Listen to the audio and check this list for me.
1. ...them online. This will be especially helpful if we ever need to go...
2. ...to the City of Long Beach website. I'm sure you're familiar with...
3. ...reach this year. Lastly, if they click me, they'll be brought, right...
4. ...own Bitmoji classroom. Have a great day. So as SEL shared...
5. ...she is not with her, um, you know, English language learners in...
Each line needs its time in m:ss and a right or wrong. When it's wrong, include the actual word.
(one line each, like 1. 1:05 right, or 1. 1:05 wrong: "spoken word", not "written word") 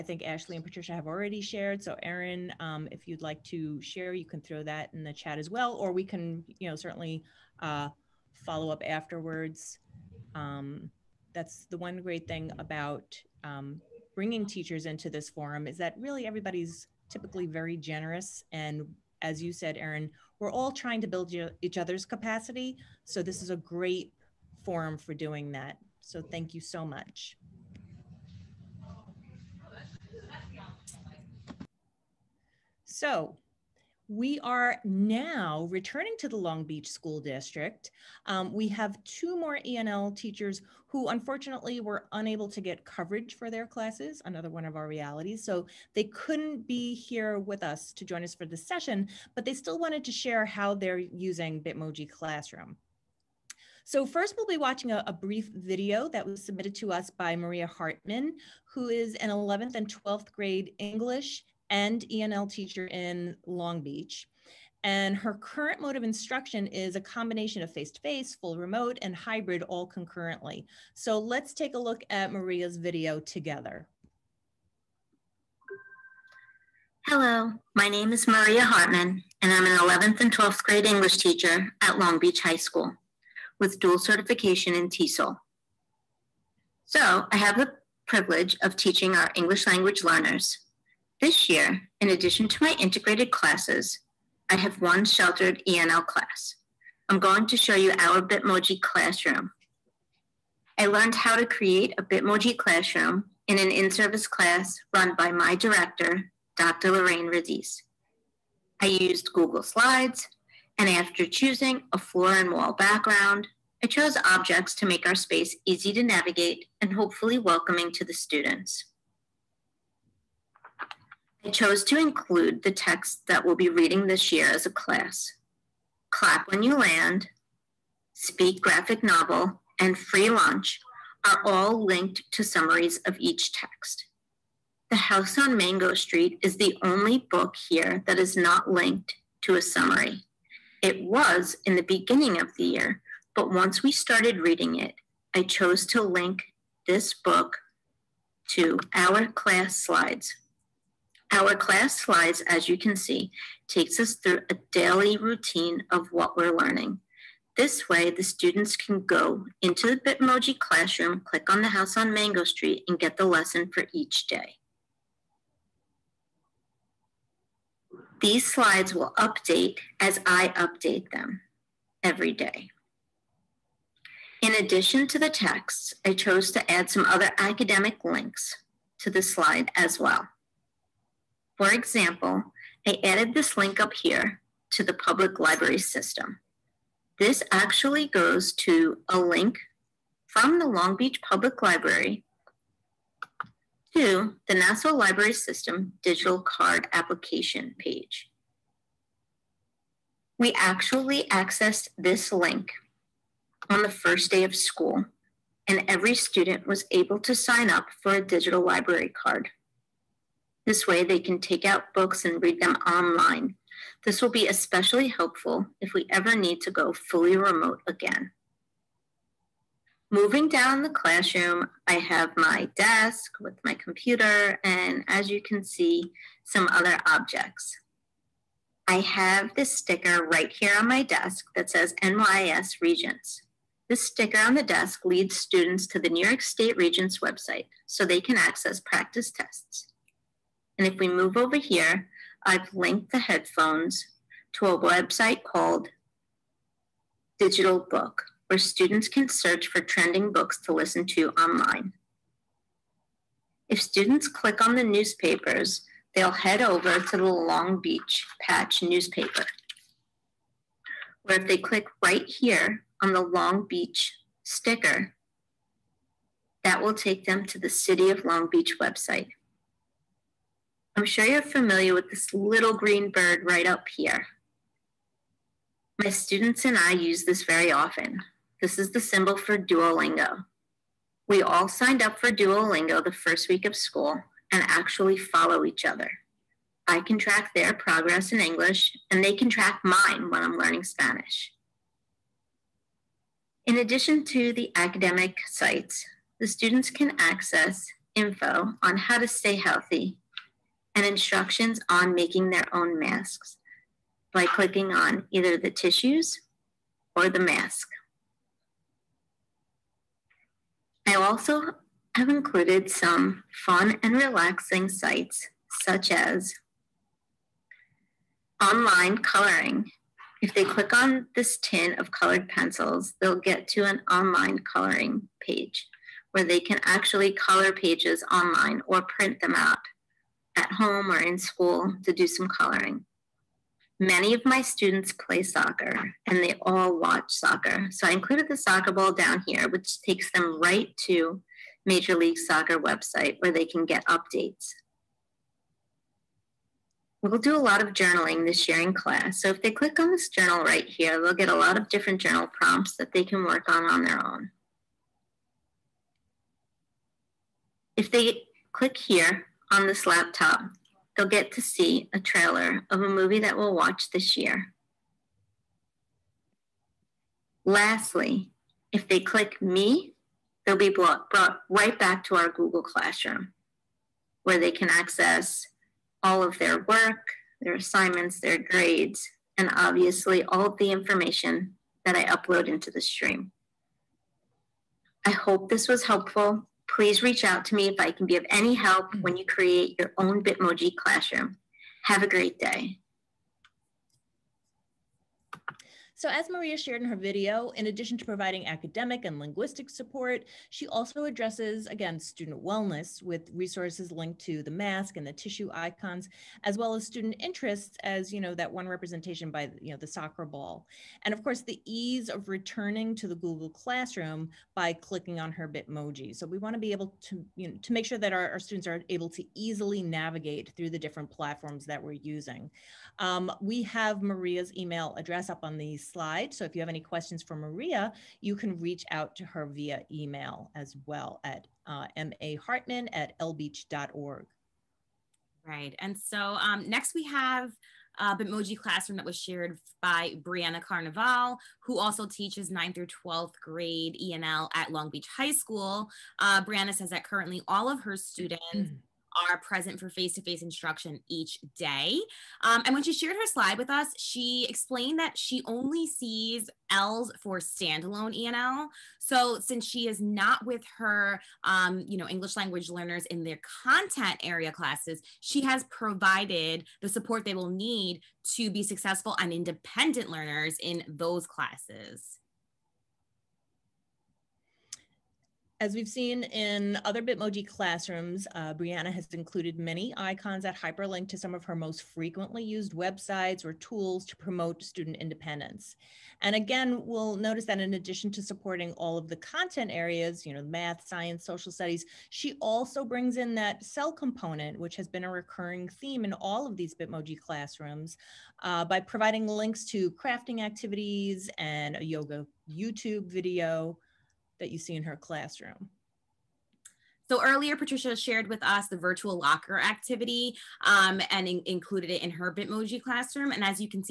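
1. 3:32 right
2. 4:27 right
3. 6:03 wrong: "watch", not "reach"
4. 6:30 wrong: "Maria", not "SEL"
5. 7:39 right.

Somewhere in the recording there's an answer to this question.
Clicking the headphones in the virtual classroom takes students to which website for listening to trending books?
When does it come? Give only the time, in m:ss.
4:07.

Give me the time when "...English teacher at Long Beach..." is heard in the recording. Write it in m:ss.
1:20.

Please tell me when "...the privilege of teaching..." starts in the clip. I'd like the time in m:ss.
1:27.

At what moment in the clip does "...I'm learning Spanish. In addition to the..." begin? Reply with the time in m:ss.
4:50.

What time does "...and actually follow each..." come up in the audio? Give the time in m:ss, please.
4:44.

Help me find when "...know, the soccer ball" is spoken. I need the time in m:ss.
6:49.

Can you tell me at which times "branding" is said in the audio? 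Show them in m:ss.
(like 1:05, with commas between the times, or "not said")
not said.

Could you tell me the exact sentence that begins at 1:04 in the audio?
And her current mode of instruction is a combination of face-to-face, -face, full remote, and hybrid all concurrently.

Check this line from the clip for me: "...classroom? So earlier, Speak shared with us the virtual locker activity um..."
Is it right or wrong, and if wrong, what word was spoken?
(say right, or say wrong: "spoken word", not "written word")
wrong: "Patricia", not "Speak".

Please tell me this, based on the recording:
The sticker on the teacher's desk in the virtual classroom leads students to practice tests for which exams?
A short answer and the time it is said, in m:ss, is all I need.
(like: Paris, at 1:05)
NYS Regents, at 3:52.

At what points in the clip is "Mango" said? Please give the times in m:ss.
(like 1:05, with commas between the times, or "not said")
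2:15, 2:42.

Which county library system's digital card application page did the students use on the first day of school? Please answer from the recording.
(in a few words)
Nassau.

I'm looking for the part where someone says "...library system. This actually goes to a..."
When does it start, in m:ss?
3:05.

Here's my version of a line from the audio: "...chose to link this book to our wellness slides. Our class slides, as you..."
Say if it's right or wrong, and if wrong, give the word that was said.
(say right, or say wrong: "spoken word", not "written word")
wrong: "class", not "wellness".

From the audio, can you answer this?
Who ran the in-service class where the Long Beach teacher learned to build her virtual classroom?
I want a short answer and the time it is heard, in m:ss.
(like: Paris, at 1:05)
Dr. Lorraine Radice, at 1:46.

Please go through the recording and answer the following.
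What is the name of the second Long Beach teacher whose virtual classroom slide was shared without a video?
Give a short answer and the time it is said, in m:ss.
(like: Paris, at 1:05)
Brianna Carnevale, at 7:20.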